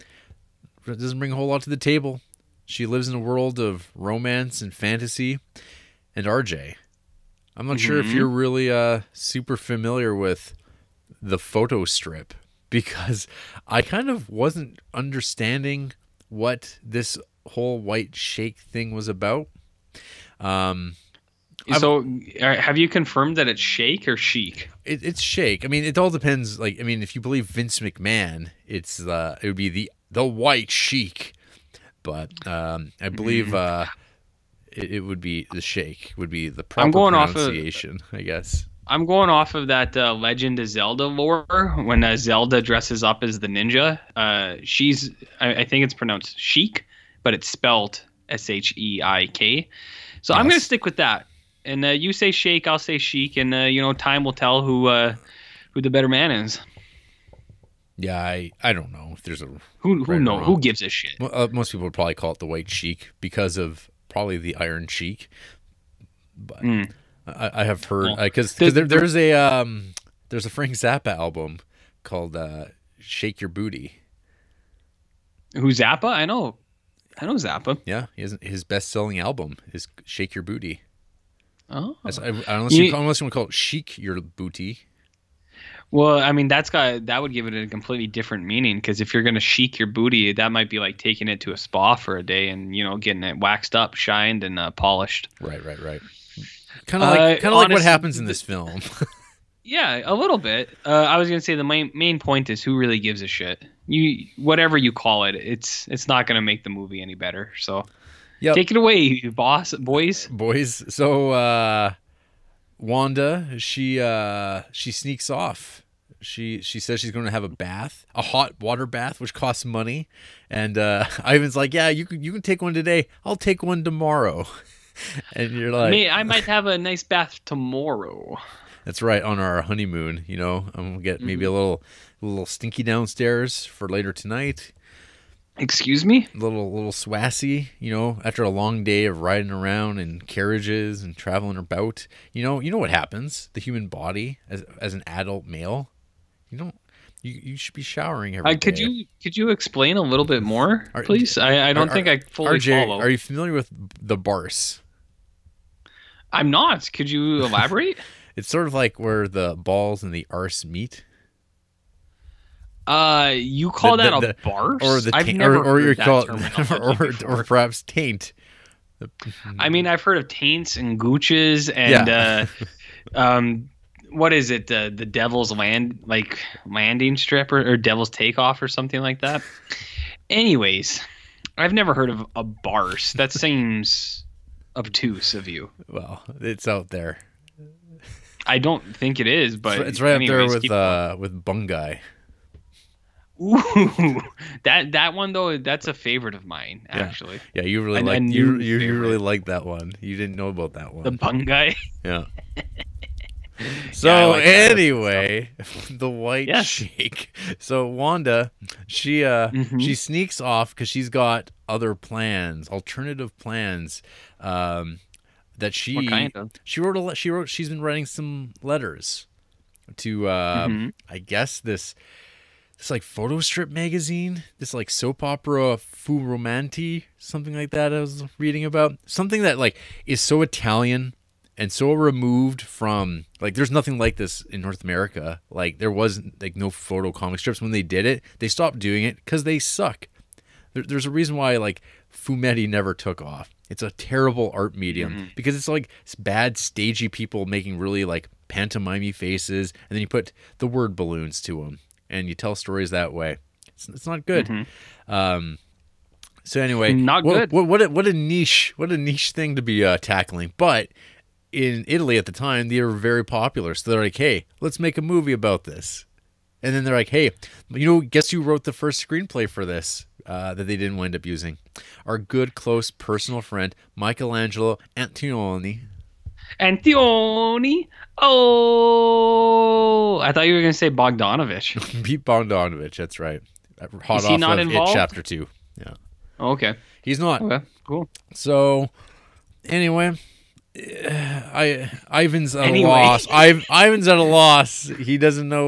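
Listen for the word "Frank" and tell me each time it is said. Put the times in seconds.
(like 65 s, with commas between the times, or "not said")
70 s.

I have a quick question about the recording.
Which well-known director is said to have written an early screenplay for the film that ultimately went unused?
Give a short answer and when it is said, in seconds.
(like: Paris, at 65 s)
Michelangelo Antonioni, at 273 s.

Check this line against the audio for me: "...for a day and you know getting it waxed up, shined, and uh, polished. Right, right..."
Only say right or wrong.
right.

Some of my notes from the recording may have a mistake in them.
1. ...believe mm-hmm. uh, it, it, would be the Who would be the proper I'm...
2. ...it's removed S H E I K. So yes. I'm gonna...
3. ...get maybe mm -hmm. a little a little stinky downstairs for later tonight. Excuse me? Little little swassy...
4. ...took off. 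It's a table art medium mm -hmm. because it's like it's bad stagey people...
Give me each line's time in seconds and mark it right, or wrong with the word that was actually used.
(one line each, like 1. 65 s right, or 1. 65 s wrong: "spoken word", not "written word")
1. 33 s wrong: "Sheik", not "Who"
2. 47 s wrong: "spelled", not "removed"
3. 131 s right
4. 242 s wrong: "terrible", not "table".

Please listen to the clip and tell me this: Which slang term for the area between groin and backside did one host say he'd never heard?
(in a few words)
barse.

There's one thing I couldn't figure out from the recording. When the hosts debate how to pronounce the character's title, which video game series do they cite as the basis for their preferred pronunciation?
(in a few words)
Legend of Zelda.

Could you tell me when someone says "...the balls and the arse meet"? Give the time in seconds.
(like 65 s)
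159 s.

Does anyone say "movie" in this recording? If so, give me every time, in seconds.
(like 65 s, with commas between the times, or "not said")
106 s, 265 s.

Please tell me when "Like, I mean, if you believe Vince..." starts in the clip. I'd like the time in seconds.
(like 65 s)
26 s.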